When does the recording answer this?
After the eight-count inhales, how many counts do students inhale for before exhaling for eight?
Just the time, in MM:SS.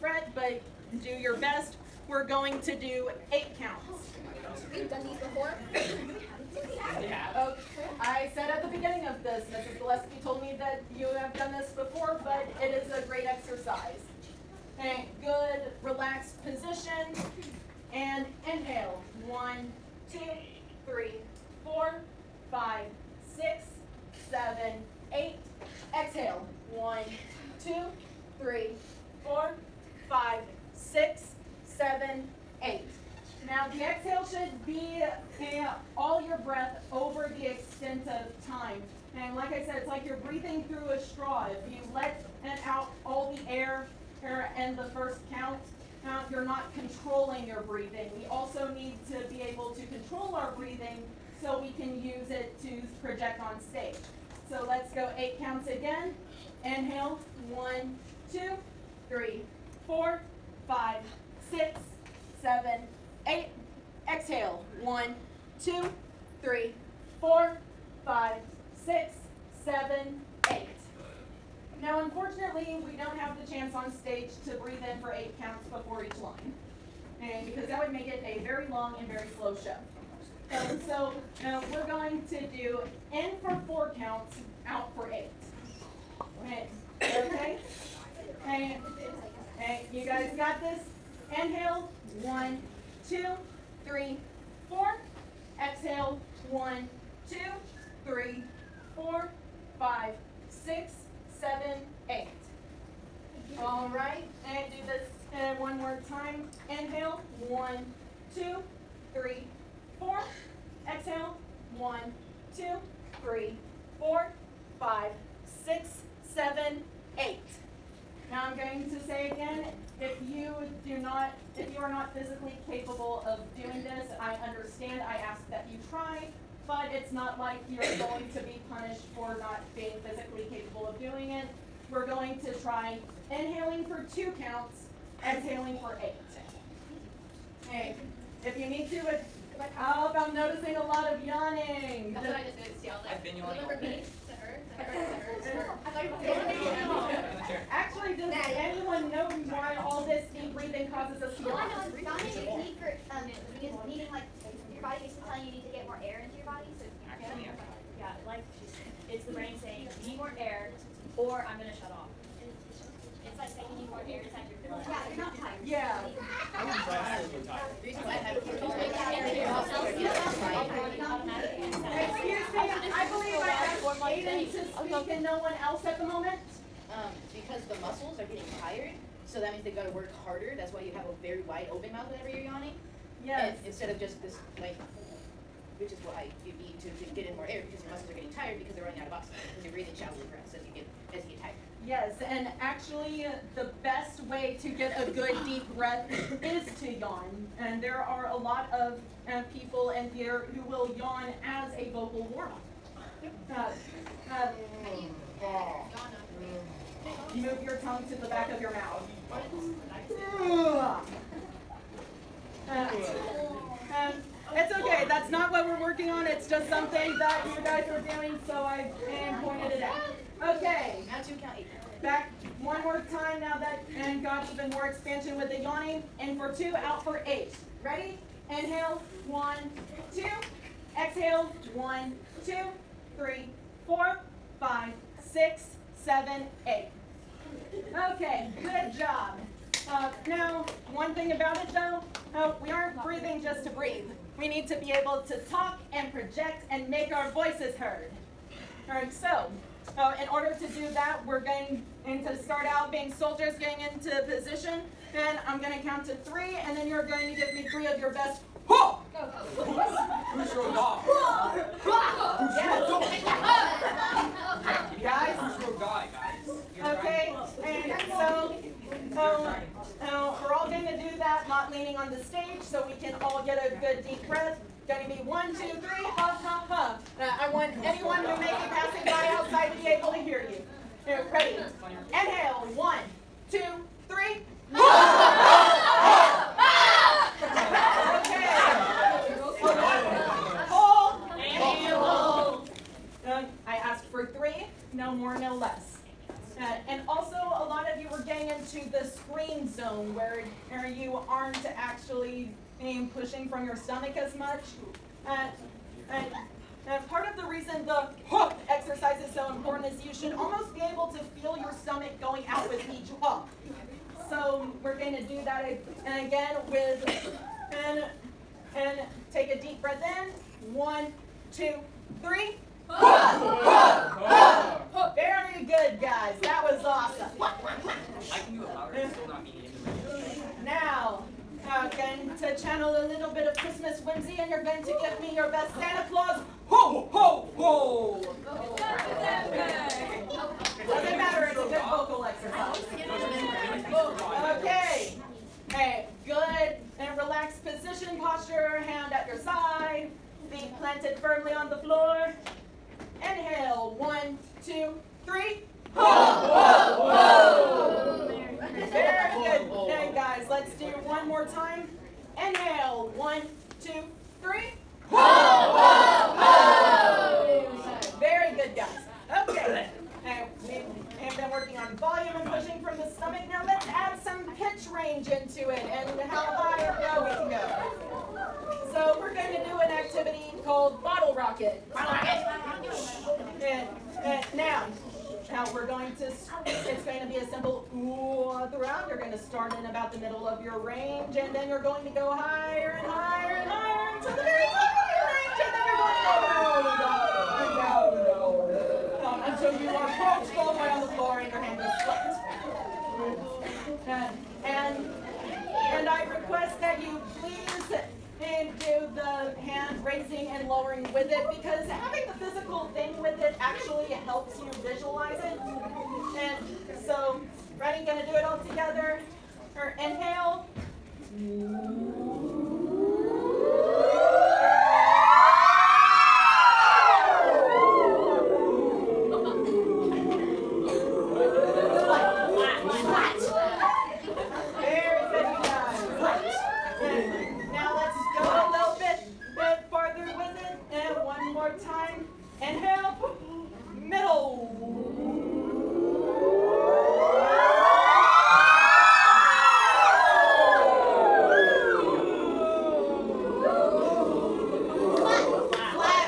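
02:14.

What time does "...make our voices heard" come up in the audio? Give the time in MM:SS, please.
04:06.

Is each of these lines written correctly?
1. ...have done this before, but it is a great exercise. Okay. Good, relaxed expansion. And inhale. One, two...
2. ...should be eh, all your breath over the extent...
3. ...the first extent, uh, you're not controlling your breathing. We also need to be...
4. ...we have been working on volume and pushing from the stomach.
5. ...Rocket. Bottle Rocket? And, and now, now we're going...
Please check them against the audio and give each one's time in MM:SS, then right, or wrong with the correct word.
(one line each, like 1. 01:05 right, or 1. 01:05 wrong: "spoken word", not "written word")
1. 00:11 wrong: "position", not "expansion"
2. 00:34 right
3. 00:44 wrong: "count", not "extent"
4. 06:10 right
5. 06:21 right.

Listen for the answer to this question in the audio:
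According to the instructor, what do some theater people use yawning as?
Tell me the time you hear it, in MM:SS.
03:21.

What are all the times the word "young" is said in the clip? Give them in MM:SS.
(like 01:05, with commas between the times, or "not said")
not said.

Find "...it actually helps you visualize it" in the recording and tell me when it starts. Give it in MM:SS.
06:53.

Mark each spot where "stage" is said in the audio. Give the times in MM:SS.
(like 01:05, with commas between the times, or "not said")
00:53, 01:13, 04:32.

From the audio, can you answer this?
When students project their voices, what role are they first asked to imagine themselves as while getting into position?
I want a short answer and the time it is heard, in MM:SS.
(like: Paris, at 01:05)
soldiers, at 04:13.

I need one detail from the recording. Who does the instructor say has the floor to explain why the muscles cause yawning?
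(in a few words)
Aiden.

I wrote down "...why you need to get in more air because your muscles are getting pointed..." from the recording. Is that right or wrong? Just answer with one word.
wrong.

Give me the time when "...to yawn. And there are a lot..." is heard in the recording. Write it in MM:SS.
03:16.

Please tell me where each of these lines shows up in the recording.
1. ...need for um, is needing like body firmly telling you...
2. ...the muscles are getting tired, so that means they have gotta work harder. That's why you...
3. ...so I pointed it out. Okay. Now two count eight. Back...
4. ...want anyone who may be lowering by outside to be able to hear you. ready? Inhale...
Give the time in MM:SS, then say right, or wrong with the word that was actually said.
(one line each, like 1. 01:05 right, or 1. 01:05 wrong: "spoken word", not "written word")
1. 02:32 wrong: "basically", not "firmly"
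2. 02:57 right
3. 03:38 right
4. 04:37 wrong: "passing", not "lowering".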